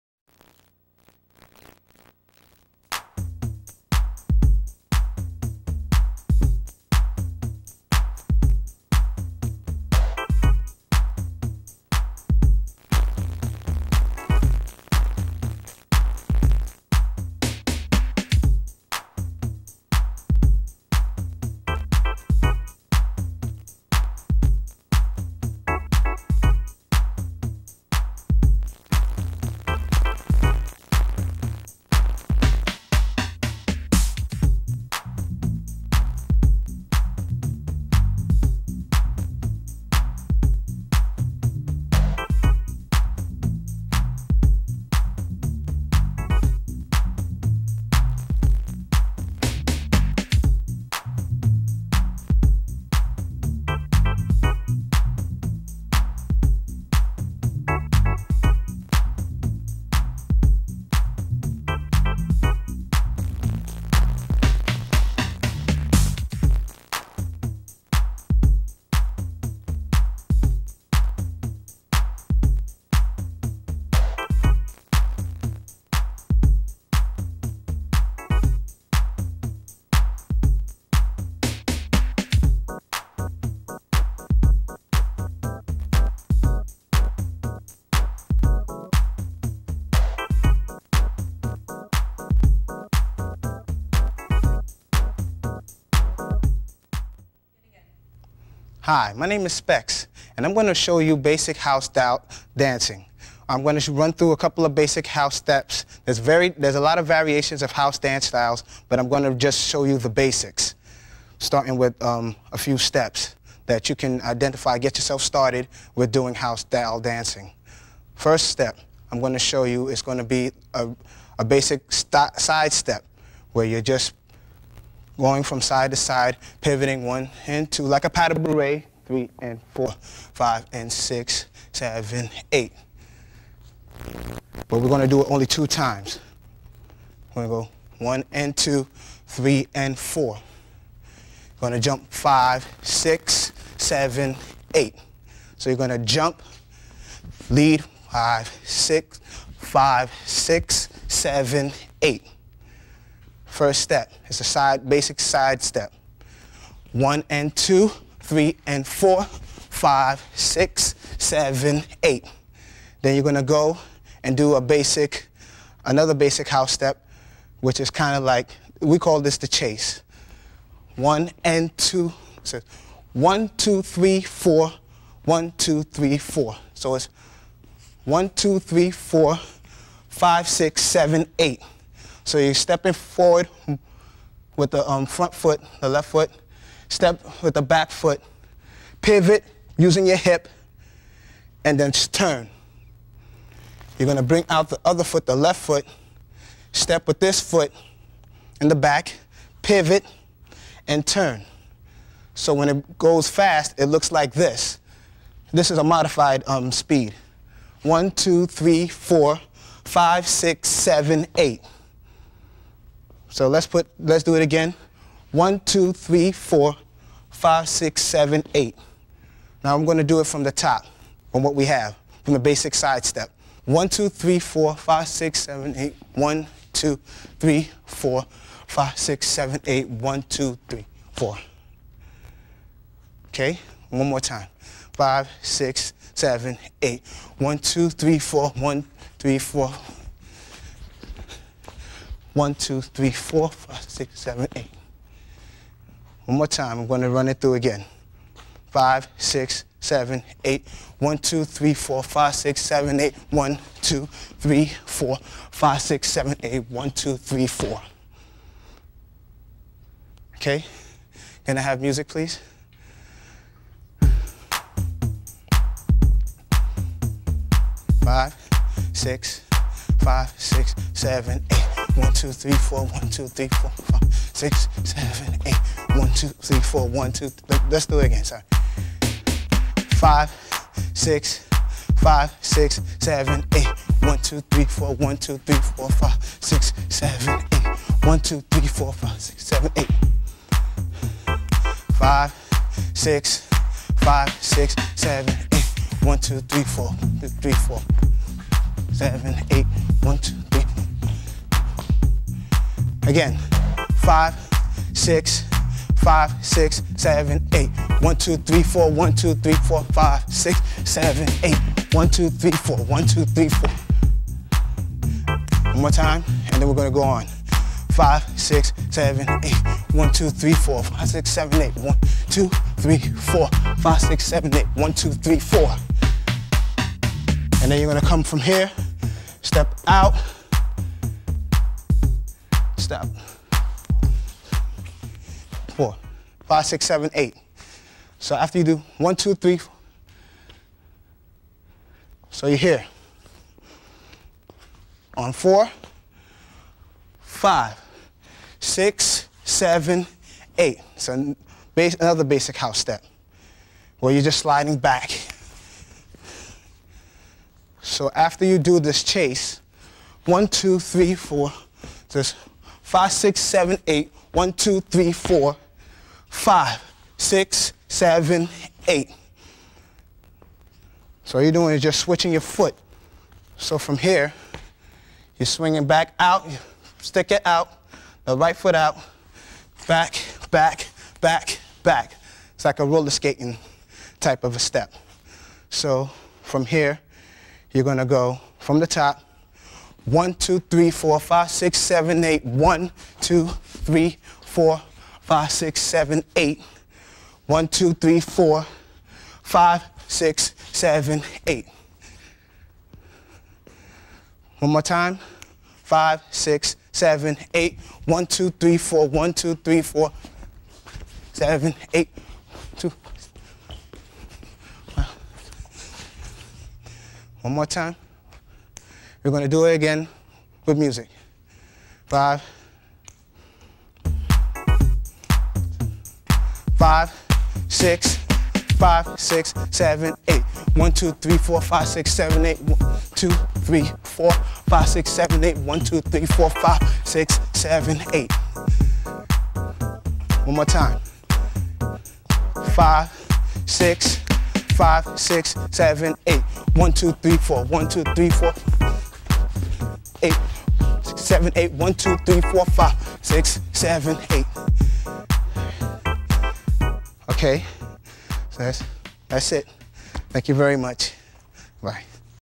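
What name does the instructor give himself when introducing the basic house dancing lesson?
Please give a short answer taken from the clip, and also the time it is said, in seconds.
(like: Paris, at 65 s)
Specs, at 99 s.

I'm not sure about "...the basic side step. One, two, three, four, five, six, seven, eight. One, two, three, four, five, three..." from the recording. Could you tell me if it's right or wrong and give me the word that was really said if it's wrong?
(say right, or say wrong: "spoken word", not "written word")
wrong: "six", not "three".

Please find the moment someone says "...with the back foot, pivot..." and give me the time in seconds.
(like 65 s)
187 s.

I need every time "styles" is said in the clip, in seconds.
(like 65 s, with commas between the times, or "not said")
108 s, 116 s.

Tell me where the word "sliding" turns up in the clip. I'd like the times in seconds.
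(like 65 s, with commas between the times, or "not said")
354 s.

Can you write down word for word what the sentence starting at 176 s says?
So it's one, two, three, four, five, six, seven, eight.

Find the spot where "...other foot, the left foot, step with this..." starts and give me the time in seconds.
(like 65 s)
194 s.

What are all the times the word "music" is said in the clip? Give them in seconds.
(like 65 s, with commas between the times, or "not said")
261 s, 420 s.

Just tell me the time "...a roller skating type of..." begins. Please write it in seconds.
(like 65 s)
382 s.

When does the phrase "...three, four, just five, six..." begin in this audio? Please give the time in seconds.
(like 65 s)
360 s.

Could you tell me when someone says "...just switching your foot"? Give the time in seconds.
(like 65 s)
371 s.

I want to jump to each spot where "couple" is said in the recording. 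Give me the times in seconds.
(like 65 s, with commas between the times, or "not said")
104 s.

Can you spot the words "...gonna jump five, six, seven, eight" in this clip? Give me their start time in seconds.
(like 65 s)
141 s.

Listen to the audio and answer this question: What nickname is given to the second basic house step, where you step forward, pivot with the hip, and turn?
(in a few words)
the chase.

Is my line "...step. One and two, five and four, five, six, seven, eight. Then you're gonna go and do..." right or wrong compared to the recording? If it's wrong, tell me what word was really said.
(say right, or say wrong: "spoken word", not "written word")
wrong: "three", not "five".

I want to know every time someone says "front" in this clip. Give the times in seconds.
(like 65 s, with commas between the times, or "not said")
185 s.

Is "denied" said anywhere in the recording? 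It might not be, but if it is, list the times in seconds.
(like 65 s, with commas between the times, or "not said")
not said.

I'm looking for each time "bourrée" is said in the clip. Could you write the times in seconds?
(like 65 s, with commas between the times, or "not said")
128 s.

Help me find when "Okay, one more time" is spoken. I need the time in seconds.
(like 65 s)
233 s.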